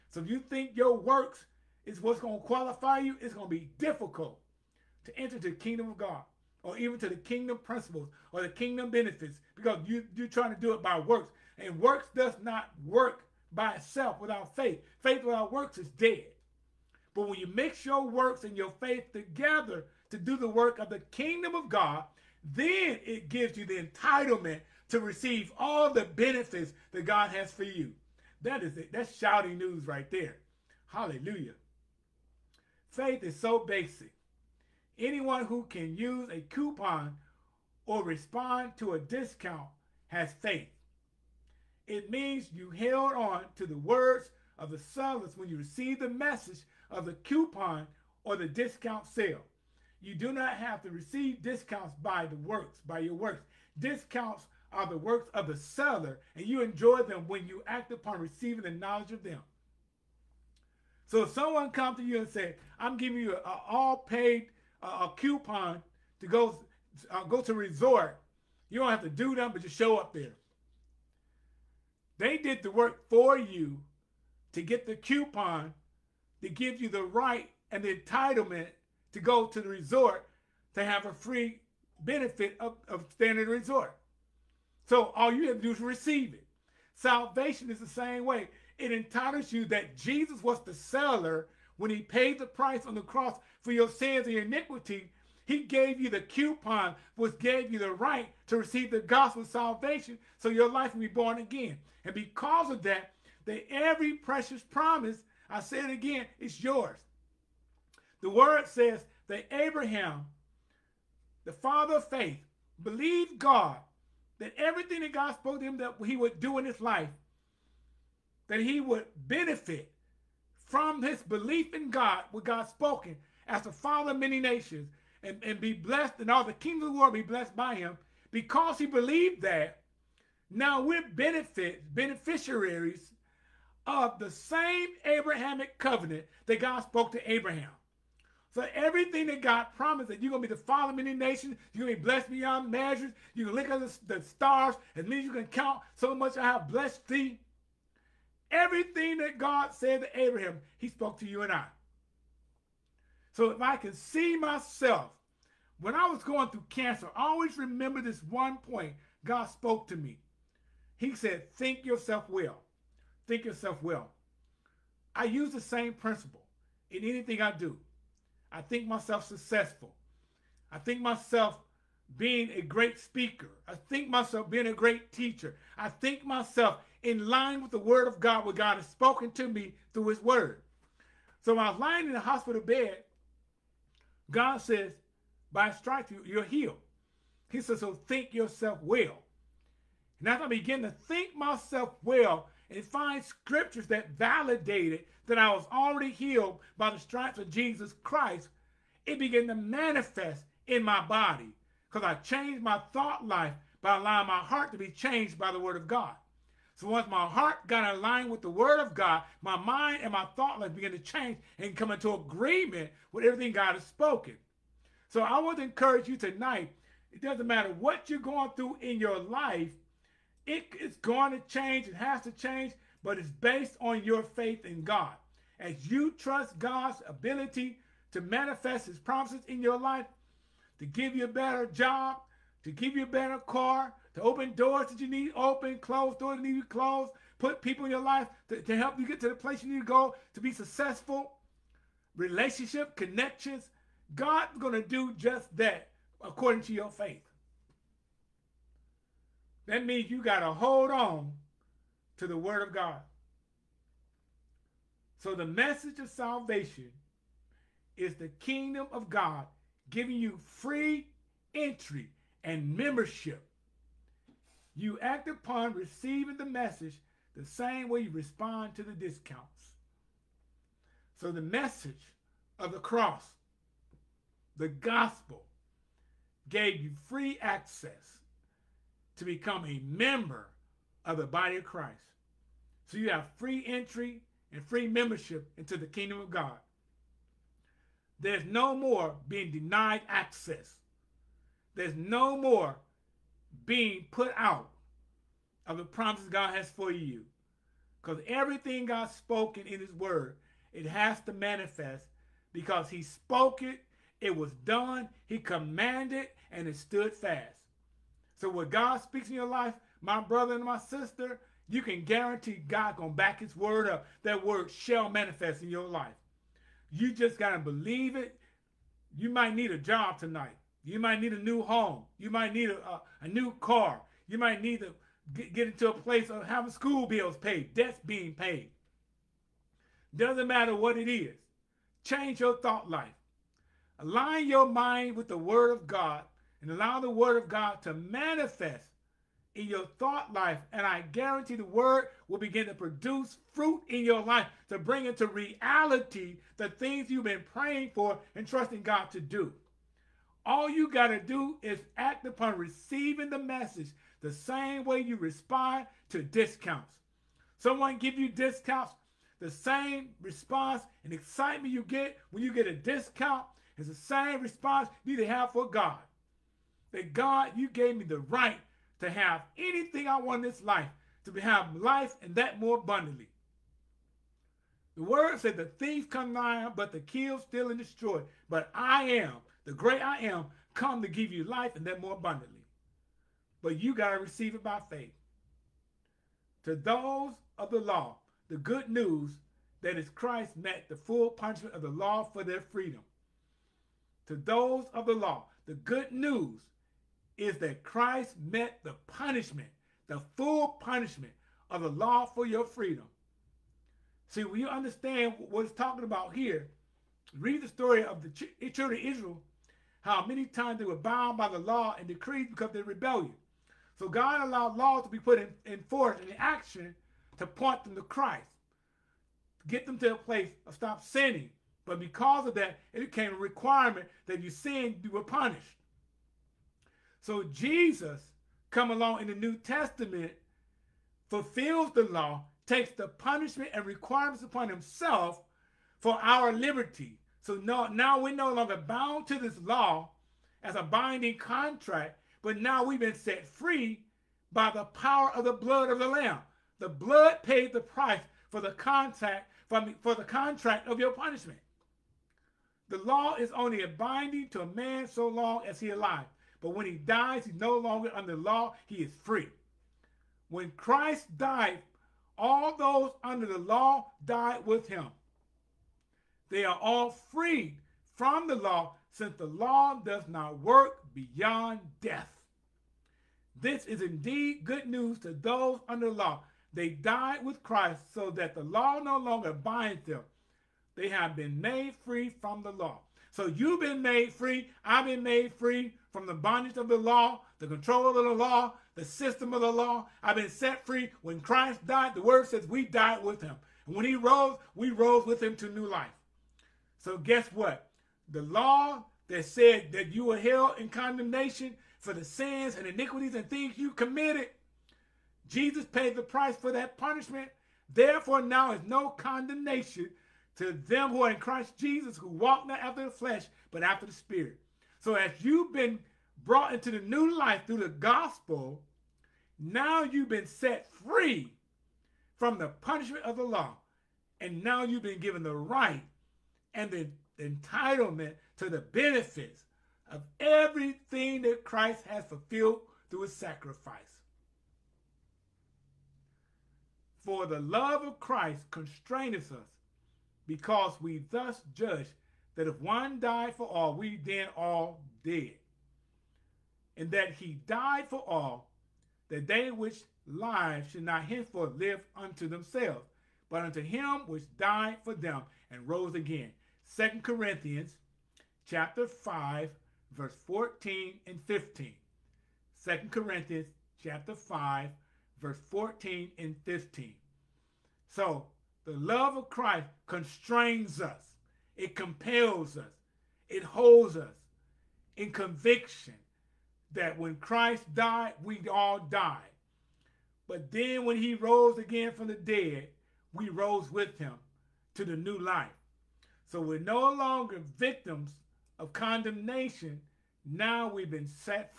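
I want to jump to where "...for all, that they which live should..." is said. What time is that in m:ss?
9:08.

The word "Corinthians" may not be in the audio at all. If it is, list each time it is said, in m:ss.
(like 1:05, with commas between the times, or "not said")
9:17, 9:23.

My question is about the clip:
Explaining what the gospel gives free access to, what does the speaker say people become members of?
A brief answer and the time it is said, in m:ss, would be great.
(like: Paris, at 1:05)
the body of Christ, at 4:41.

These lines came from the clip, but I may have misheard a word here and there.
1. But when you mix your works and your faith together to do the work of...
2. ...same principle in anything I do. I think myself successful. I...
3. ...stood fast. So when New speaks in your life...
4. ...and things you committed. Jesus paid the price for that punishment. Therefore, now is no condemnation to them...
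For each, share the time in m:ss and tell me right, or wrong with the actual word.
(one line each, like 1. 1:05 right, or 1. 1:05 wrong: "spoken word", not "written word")
1. 0:17 right
2. 2:45 right
3. 5:06 wrong: "God", not "New"
4. 8:23 right.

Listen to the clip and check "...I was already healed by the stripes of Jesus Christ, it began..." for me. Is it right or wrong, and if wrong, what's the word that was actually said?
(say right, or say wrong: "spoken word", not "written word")
right.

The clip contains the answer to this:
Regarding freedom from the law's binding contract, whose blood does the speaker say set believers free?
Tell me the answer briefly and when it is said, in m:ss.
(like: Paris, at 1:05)
The Lamb, at 7:26.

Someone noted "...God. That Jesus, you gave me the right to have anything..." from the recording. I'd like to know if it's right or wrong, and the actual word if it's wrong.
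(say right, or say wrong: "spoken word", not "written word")
wrong: "God", not "Jesus".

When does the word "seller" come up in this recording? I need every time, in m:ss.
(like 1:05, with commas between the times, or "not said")
0:44, 0:55, 1:30.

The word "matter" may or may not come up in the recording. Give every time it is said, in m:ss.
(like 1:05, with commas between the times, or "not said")
3:37, 5:30.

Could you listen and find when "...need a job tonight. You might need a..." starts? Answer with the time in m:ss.
5:19.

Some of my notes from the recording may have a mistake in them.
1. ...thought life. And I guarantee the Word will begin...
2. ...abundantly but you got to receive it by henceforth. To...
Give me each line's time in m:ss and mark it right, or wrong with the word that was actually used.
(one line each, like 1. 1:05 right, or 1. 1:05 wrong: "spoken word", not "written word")
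1. 5:39 right
2. 6:22 wrong: "faith", not "henceforth".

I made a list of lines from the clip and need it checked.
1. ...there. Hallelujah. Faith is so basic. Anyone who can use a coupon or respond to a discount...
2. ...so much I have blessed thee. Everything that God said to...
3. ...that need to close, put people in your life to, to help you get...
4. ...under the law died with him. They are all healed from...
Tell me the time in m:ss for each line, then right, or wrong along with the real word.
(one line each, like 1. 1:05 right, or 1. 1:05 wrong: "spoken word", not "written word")
1. 0:30 right
2. 2:25 right
3. 3:56 right
4. 7:43 wrong: "freed", not "healed".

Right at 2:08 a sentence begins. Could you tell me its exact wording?
Because he believed that, now we're benefit beneficiaries of the same Abrahamic covenant that God spoke to Abraham.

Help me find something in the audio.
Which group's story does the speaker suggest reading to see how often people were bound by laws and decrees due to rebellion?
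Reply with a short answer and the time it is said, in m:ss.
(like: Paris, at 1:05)
The children of Israel, at 6:48.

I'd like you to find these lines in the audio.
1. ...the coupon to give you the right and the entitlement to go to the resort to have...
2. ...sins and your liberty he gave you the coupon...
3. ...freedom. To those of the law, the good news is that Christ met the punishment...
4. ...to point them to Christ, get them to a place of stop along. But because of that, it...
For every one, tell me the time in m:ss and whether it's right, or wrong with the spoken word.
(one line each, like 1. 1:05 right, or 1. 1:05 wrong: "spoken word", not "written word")
1. 1:14 right
2. 1:33 wrong: "iniquity", not "liberty"
3. 6:32 right
4. 6:57 wrong: "sinning", not "along".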